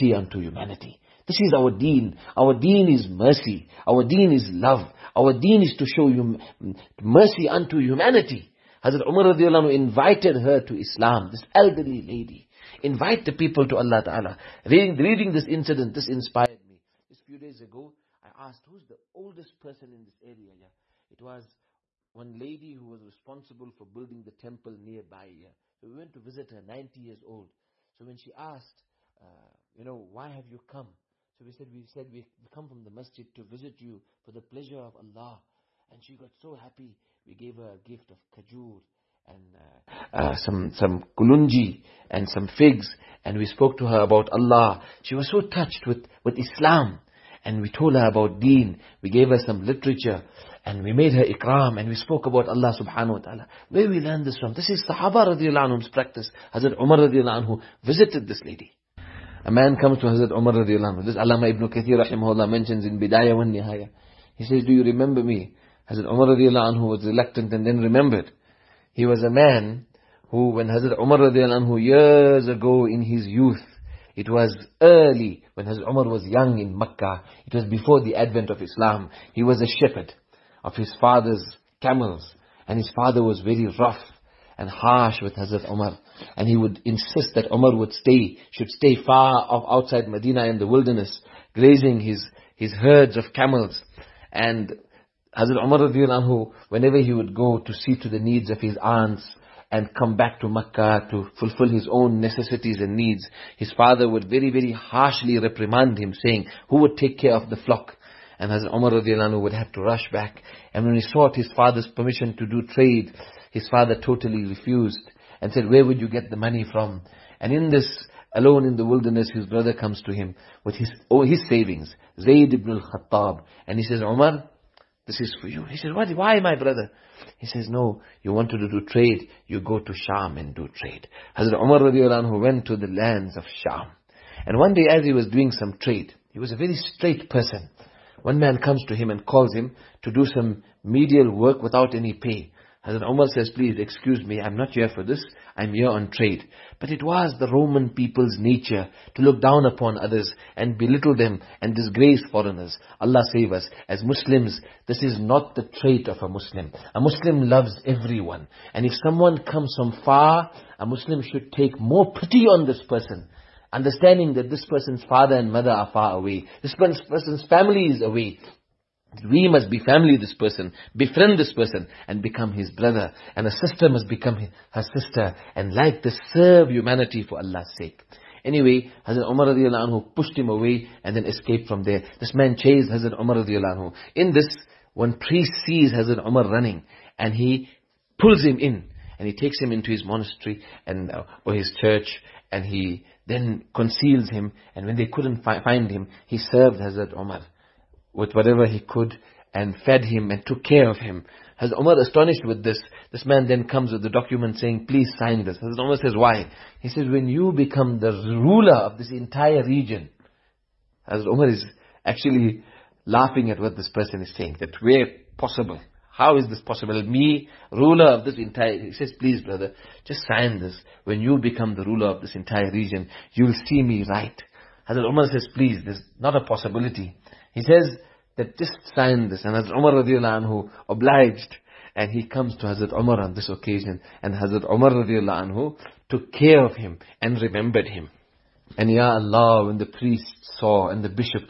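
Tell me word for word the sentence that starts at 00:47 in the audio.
And we told her about deen.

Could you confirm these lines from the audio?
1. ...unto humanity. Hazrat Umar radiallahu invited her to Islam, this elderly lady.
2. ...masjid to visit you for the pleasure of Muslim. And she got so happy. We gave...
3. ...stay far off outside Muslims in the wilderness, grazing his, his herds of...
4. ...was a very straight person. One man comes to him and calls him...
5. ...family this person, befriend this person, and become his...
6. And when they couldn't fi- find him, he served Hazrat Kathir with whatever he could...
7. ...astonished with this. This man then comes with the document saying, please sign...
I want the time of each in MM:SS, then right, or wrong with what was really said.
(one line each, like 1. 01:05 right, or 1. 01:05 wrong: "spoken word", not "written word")
1. 00:07 right
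2. 00:32 wrong: "Allah", not "Muslim"
3. 01:28 wrong: "Medina", not "Muslims"
4. 02:16 right
5. 02:49 right
6. 03:14 wrong: "Umar", not "Kathir"
7. 03:22 right.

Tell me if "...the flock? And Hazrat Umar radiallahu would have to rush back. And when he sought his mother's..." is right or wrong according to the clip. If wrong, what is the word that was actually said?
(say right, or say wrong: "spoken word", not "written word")
wrong: "father", not "mother".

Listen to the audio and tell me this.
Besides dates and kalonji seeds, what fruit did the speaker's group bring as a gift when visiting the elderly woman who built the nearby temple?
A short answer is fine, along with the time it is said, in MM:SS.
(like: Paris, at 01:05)
Figs, at 00:42.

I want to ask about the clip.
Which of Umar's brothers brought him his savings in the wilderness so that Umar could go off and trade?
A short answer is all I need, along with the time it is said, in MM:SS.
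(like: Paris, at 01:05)
Zayd ibn al-Khattab, at 02:02.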